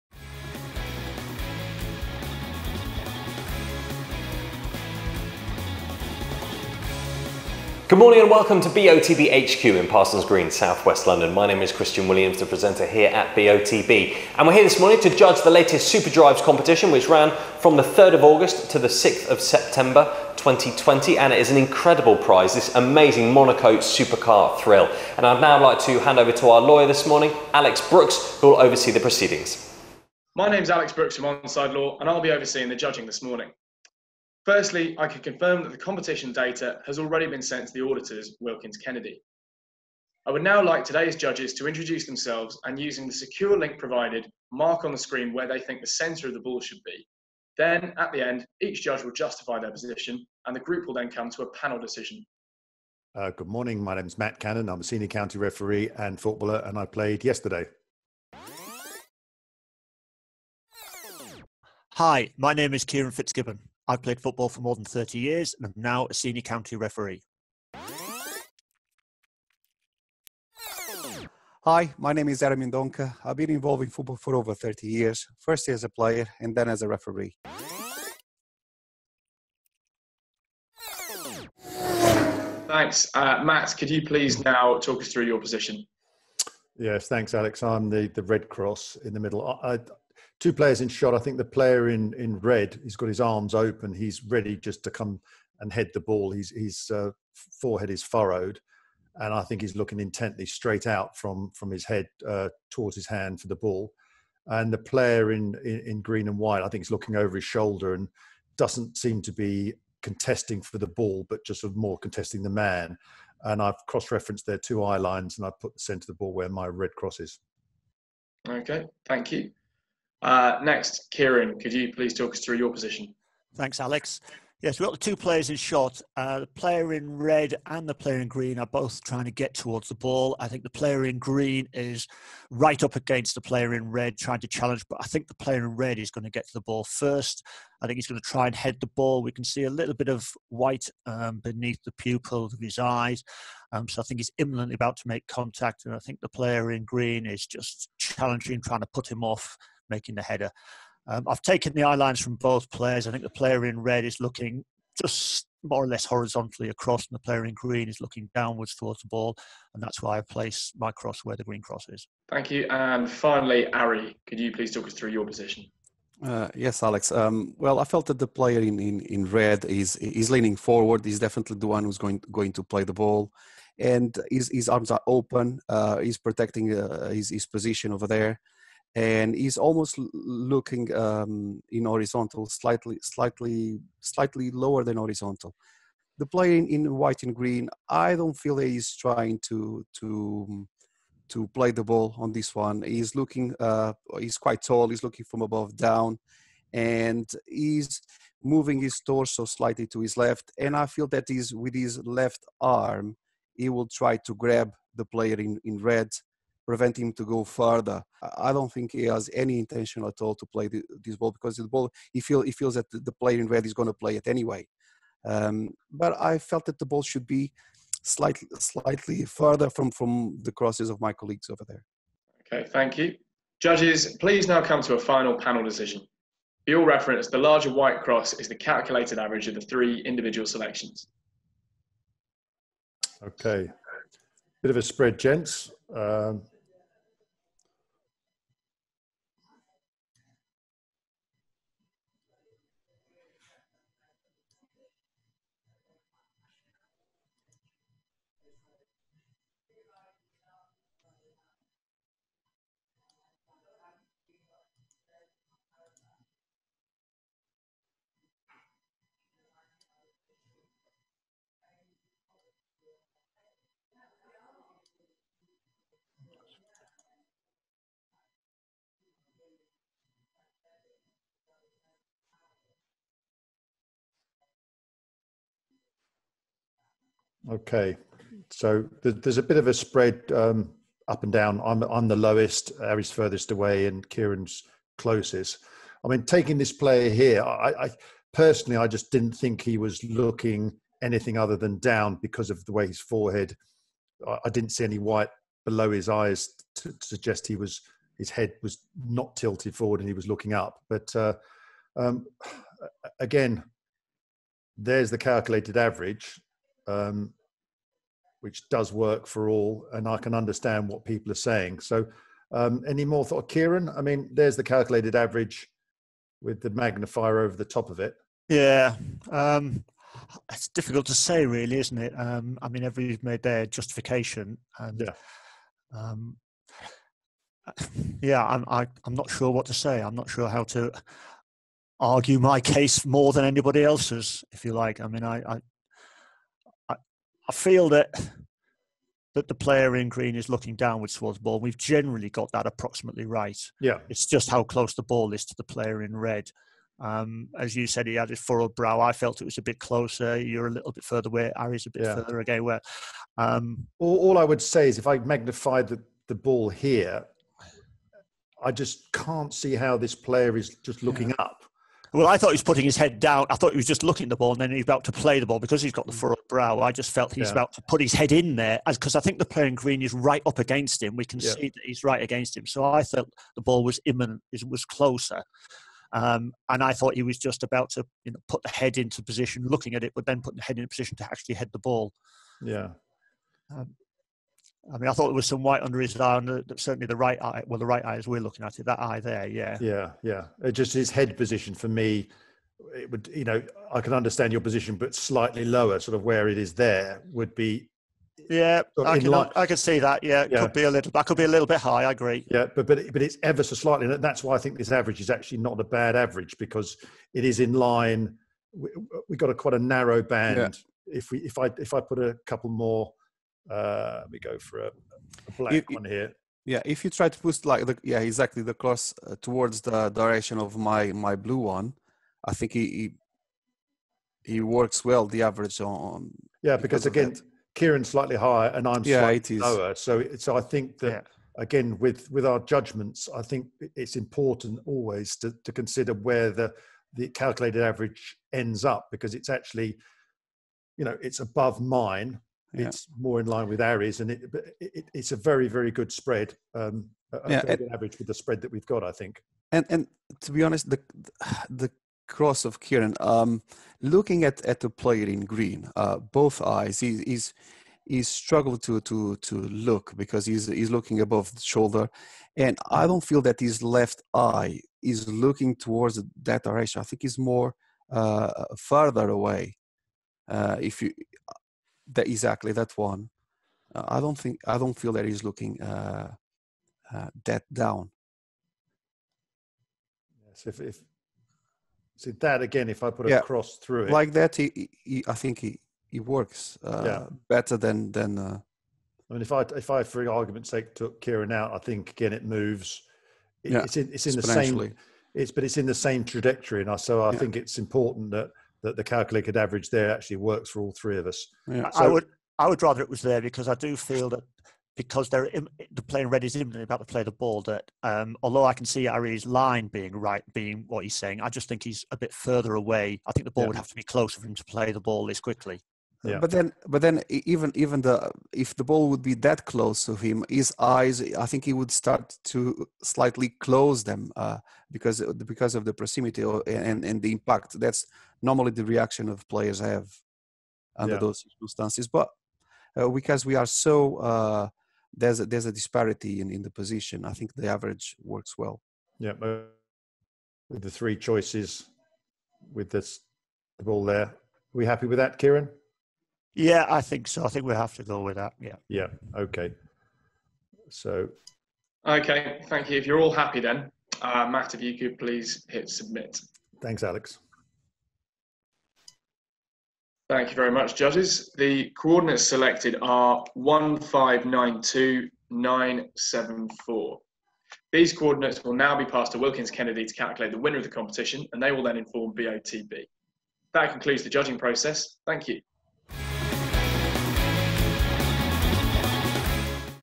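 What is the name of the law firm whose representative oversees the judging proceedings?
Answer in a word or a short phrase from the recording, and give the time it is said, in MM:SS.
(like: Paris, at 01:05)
Onside Law, at 00:31.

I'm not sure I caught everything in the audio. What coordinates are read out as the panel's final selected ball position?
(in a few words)
1592974.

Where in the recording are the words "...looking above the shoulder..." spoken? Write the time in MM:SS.
07:40.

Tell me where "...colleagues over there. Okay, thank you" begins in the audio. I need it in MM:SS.
03:41.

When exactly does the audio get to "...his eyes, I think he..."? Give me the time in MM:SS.
08:40.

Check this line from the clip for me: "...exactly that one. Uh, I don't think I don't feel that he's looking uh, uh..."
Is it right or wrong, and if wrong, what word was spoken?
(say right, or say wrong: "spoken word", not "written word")
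right.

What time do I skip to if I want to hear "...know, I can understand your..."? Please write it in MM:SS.
06:33.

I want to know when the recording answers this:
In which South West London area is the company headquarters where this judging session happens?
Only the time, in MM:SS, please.
00:09.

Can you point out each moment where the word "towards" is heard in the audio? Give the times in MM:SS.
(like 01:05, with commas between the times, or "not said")
01:42, 02:09, 02:38, 05:41, 06:59, 07:45.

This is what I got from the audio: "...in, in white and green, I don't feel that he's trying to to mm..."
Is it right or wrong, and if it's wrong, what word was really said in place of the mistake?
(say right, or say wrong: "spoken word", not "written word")
right.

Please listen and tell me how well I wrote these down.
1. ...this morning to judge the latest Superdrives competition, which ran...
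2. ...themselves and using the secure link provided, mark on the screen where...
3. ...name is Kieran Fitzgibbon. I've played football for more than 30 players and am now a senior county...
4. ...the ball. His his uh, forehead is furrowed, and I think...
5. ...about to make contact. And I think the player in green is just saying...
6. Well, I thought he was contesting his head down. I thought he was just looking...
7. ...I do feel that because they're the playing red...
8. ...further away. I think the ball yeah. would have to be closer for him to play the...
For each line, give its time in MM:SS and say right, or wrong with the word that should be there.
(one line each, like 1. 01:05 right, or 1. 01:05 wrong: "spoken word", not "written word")
1. 00:14 right
2. 00:42 right
3. 01:02 wrong: "years", not "players"
4. 01:35 right
5. 02:24 wrong: "challenging", not "saying"
6. 06:02 wrong: "putting", not "contesting"
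7. 08:23 right
8. 08:32 right.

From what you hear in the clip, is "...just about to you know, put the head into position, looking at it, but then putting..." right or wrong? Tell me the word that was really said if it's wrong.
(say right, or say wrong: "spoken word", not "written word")
right.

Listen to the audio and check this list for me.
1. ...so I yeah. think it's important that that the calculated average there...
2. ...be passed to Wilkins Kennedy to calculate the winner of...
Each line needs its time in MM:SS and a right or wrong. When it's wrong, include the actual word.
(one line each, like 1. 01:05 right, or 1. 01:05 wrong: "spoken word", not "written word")
1. 08:16 right
2. 09:28 right.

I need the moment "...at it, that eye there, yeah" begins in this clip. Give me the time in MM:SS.
06:28.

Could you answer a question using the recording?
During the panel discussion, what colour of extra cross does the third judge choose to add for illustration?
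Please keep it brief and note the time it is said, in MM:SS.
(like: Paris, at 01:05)
black, at 06:55.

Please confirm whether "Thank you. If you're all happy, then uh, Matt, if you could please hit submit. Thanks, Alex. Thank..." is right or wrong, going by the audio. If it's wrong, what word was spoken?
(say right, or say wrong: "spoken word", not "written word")
right.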